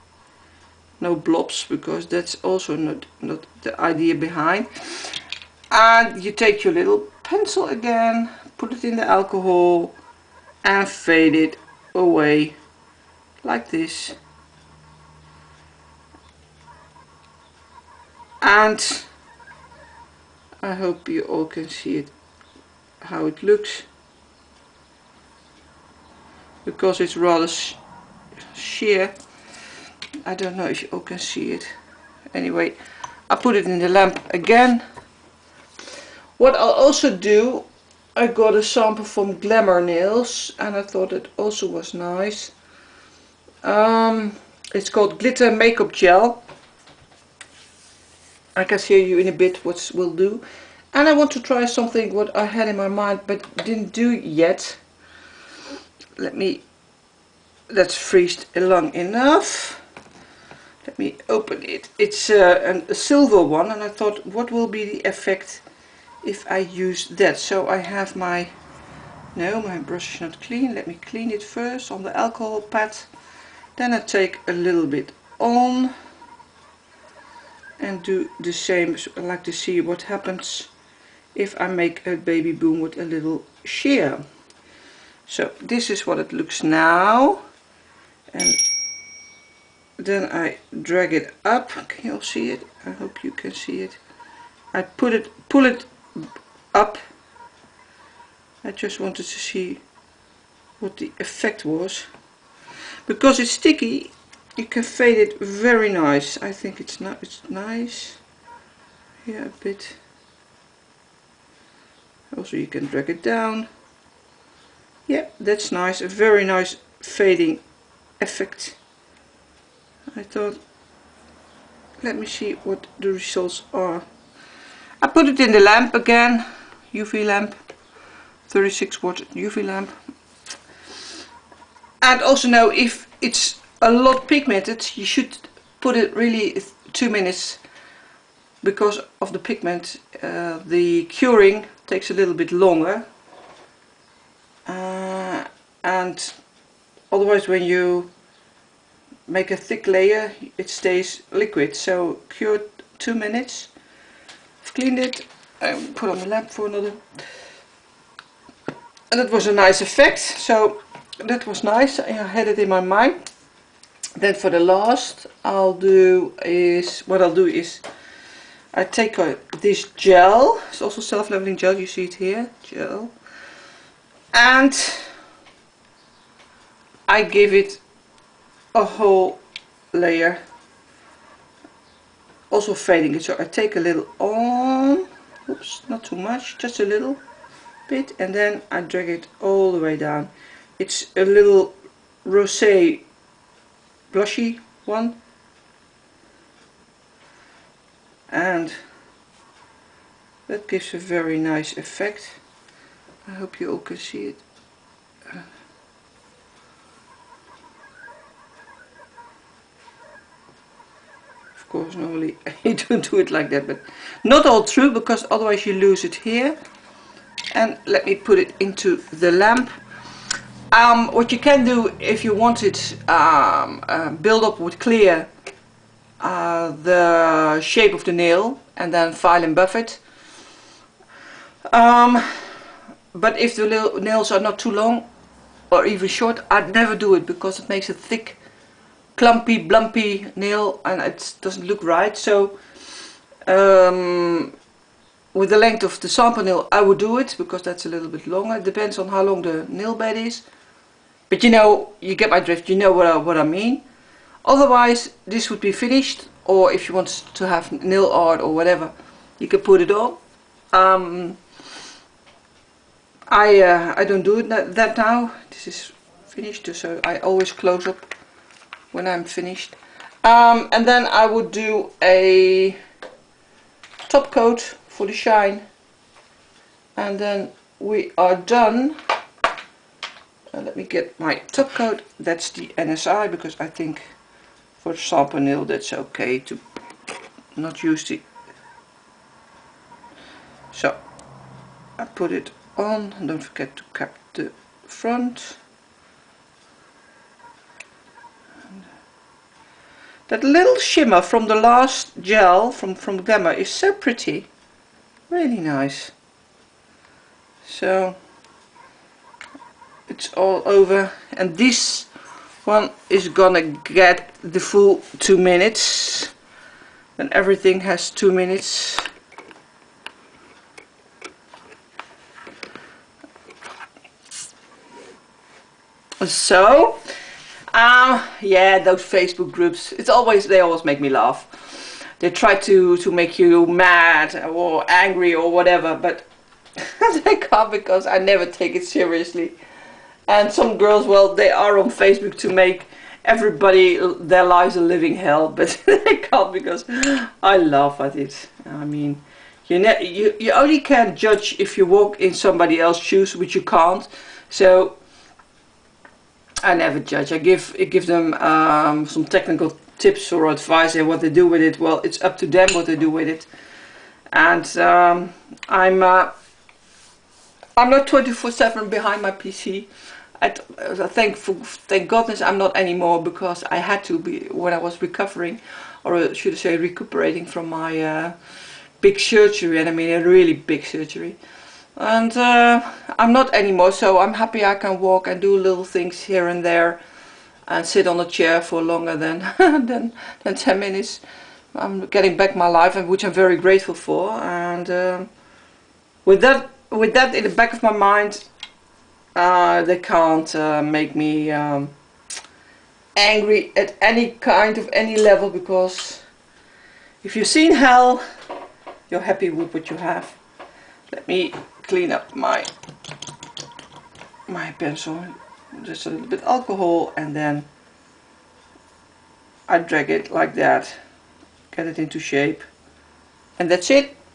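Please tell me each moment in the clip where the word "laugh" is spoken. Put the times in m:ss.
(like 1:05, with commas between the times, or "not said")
5:31, 5:47.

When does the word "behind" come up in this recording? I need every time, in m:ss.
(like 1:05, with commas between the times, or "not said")
0:04, 6:08.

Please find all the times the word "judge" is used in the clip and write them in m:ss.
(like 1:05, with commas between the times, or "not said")
5:51, 5:56.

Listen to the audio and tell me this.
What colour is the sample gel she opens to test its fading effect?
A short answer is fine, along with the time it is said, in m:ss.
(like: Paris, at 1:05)
silver, at 1:02.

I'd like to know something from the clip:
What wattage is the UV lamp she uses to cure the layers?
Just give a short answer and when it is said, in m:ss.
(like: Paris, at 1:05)
36 watt, at 2:08.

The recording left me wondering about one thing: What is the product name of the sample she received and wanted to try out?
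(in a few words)
glitter makeup gel.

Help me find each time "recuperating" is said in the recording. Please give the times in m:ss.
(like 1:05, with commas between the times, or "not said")
6:16.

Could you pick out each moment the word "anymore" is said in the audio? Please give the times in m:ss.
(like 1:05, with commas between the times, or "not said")
6:12, 6:23.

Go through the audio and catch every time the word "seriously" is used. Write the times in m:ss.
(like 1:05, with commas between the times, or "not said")
5:38.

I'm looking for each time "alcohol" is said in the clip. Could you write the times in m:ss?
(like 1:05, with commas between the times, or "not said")
0:09, 1:12, 6:56.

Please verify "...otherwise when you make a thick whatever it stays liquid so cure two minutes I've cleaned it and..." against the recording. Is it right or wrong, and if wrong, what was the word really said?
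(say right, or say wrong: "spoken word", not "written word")
wrong: "layer", not "whatever".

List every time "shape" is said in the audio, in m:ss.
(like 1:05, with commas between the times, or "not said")
3:47, 7:02.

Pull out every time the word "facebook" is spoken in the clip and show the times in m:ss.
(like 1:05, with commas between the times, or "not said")
5:29, 5:41.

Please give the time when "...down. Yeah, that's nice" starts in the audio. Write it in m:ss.
1:53.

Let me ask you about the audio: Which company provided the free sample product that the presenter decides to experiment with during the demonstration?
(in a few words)
Glamour Nails.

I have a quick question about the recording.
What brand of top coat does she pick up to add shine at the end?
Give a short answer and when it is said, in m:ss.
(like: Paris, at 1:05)
NSI, at 4:42.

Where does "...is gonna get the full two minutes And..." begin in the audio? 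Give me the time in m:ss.
5:13.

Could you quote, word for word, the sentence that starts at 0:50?
And I want to try something what I had in my mind but didn't do yet.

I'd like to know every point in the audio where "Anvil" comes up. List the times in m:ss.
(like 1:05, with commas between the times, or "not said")
not said.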